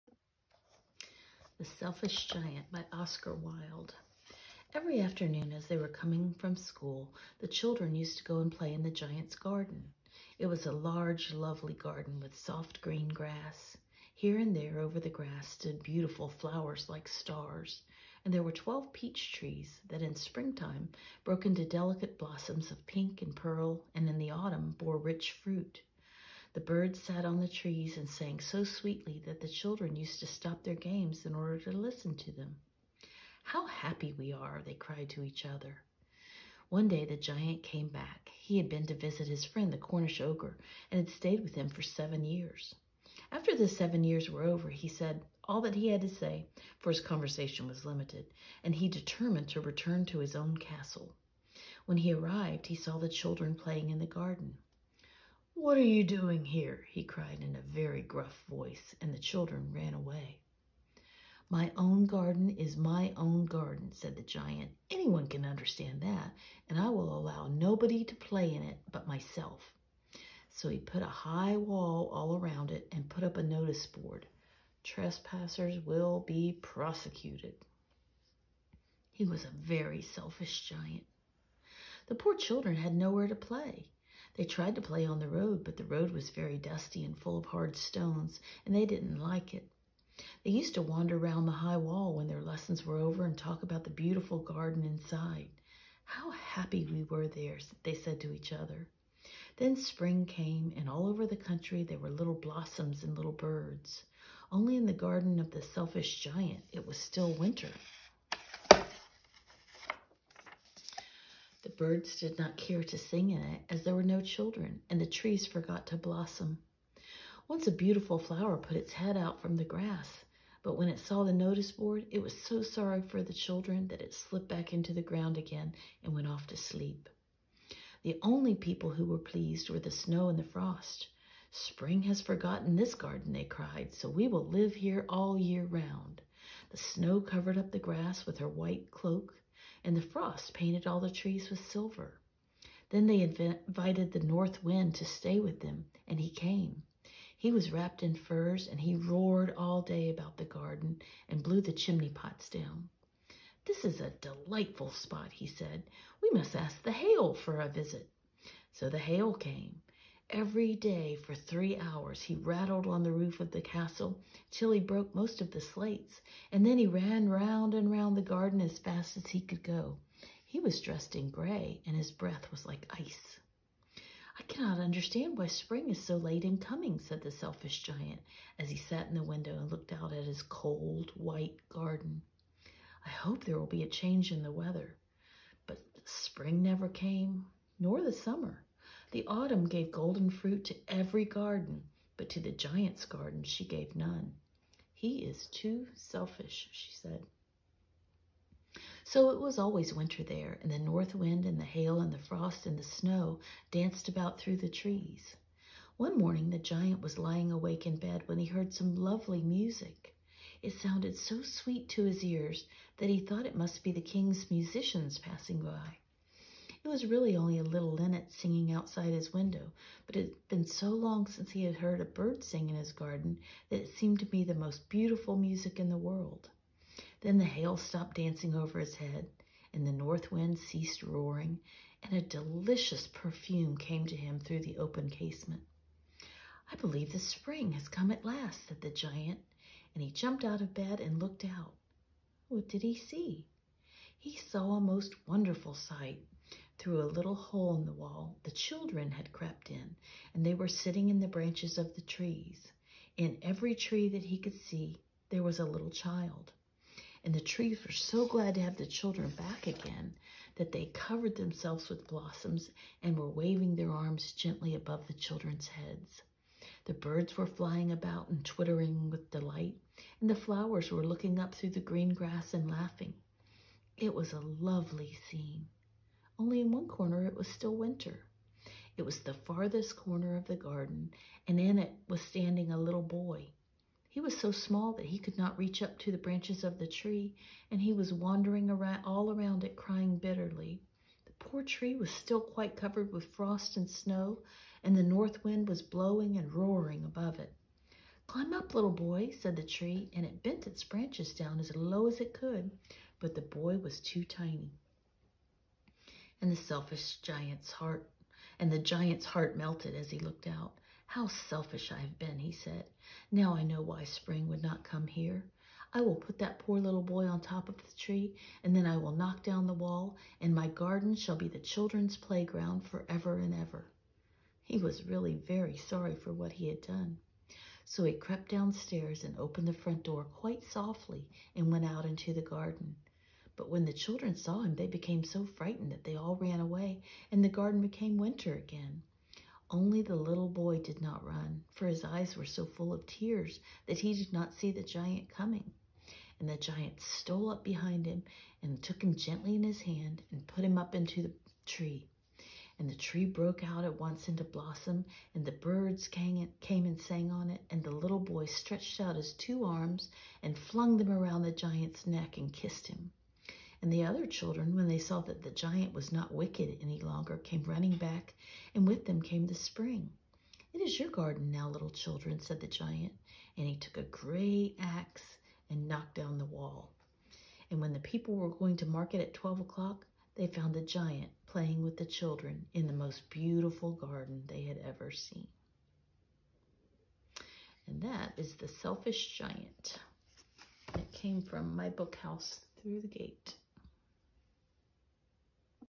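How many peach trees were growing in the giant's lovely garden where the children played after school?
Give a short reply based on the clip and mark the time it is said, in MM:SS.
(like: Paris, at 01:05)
12, at 00:18.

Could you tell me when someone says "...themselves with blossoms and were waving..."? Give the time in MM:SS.
04:21.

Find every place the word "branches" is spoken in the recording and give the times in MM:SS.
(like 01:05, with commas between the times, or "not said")
04:11, 04:46, 05:00.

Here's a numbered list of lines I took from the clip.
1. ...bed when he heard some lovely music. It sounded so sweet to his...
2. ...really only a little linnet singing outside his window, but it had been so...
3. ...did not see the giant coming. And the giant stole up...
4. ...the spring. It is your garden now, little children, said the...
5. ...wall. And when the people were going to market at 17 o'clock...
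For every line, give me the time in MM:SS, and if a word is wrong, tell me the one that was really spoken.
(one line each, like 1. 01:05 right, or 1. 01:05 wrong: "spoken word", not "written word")
1. 03:27 right
2. 03:37 right
3. 05:44 right
4. 06:09 right
5. 06:16 wrong: "12", not "17".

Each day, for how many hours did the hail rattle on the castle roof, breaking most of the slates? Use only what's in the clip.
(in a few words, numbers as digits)
3 hours.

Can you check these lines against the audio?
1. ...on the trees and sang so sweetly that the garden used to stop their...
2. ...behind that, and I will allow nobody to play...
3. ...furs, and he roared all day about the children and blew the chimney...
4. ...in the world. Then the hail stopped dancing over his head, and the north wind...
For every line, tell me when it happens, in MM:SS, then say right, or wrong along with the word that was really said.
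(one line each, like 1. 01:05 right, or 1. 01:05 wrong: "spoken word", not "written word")
1. 00:27 wrong: "children", not "garden"
2. 01:05 wrong: "understand", not "behind"
3. 02:28 wrong: "garden", not "children"
4. 03:45 right.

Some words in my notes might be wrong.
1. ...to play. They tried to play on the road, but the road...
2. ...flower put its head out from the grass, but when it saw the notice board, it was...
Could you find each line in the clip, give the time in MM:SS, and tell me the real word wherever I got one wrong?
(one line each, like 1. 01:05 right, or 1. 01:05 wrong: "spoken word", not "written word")
1. 01:23 right
2. 01:58 right.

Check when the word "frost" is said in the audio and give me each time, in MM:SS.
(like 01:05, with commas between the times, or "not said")
02:10, 02:20, 03:22, 04:53.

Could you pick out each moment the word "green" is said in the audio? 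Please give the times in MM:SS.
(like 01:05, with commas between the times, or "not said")
00:12, 04:31.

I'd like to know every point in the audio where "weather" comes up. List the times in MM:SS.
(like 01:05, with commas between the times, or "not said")
03:04.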